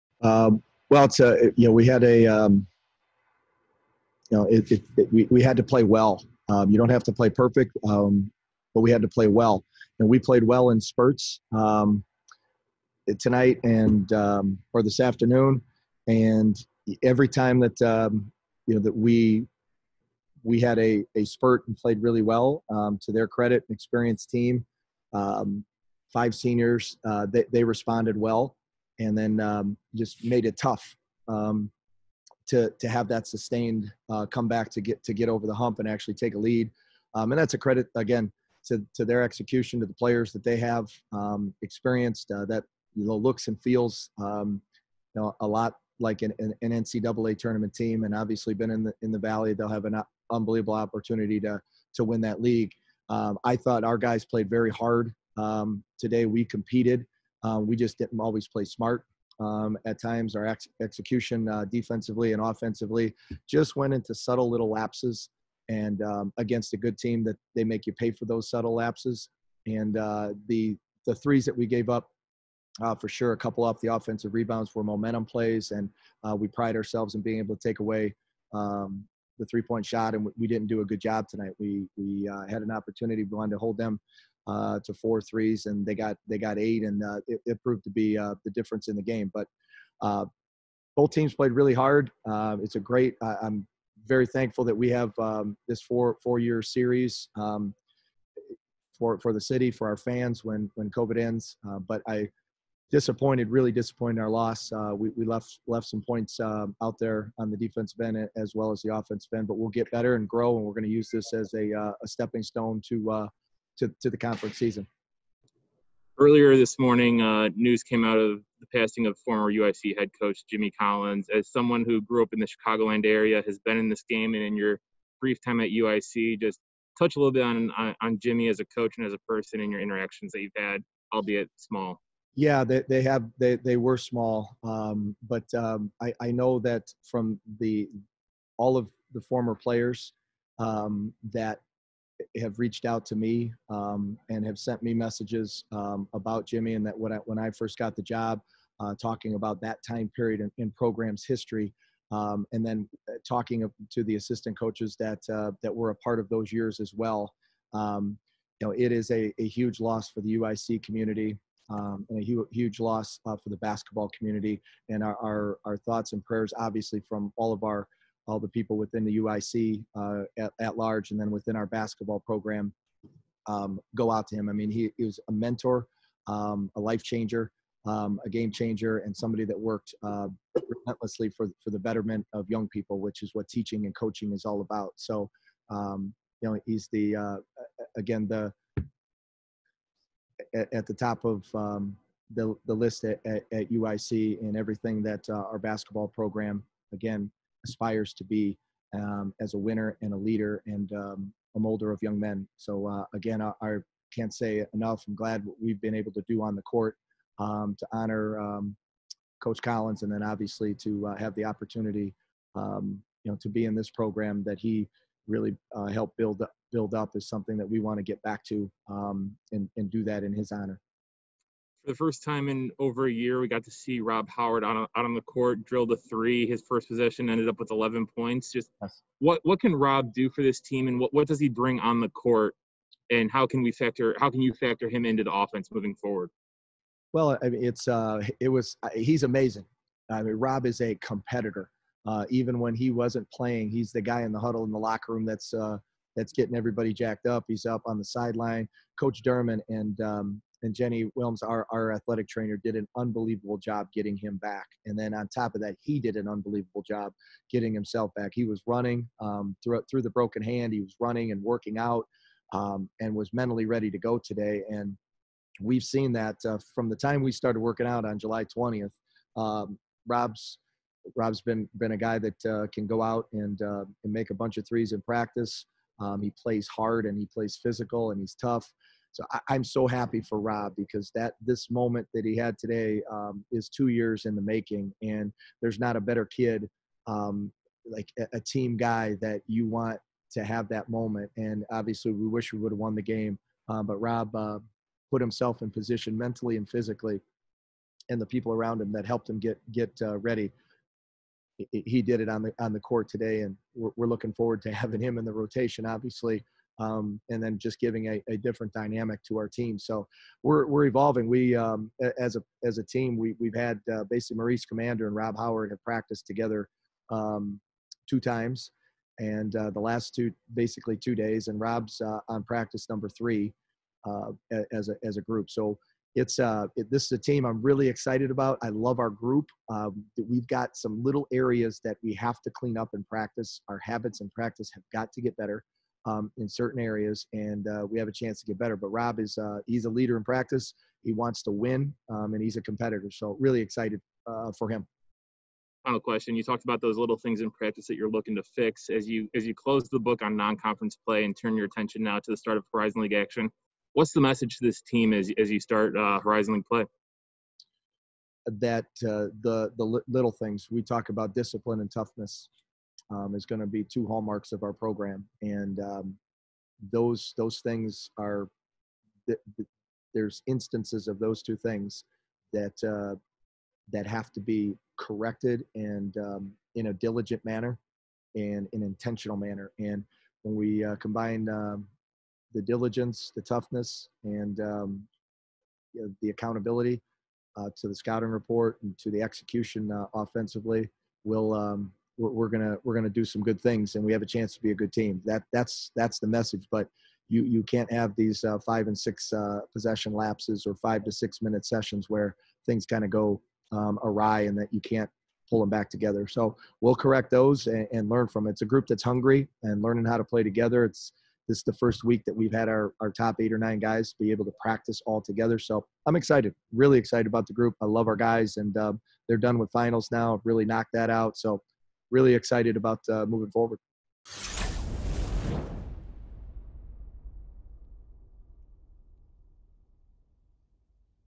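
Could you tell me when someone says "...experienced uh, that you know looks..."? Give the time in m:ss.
0:41.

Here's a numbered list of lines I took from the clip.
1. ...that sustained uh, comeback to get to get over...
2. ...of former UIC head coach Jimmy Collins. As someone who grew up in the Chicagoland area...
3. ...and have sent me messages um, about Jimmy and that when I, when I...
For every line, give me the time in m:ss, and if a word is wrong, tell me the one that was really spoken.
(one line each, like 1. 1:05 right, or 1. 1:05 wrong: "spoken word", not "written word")
1. 0:33 right
2. 1:59 right
3. 2:24 right.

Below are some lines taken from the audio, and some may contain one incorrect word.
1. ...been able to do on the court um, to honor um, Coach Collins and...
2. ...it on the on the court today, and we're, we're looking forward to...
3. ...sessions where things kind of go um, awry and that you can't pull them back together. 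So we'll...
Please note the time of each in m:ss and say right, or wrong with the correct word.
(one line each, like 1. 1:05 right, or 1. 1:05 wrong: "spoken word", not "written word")
1. 3:25 right
2. 5:02 right
3. 6:41 right.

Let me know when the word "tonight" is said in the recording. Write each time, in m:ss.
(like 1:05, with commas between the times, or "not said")
0:13, 1:21.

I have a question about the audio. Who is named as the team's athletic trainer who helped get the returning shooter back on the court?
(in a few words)
Jenny Wilms.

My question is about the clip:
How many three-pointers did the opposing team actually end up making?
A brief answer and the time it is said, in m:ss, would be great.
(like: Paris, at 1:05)
8, at 1:26.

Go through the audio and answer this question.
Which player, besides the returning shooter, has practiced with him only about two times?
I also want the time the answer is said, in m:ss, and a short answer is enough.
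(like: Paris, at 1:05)
Maurice Commander, at 5:14.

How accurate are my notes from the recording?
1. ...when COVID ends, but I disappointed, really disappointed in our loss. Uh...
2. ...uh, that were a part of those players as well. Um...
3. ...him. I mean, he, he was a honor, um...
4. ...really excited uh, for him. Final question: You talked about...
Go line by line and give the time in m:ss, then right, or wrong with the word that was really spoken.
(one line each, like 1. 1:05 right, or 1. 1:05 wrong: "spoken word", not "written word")
1. 1:40 right
2. 2:35 wrong: "years", not "players"
3. 2:54 wrong: "mentor", not "honor"
4. 5:43 right.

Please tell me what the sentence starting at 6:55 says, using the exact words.
So I'm excited, really excited about the group.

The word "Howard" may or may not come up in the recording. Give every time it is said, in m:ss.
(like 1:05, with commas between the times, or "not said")
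3:44, 5:15.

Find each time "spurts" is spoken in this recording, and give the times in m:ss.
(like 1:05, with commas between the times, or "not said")
0:10, 0:21.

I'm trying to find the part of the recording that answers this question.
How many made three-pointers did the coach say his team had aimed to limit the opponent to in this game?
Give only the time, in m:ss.
1:24.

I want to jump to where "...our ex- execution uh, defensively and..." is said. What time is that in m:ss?
1:00.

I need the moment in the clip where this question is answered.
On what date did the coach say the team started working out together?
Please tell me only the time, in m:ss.
4:28.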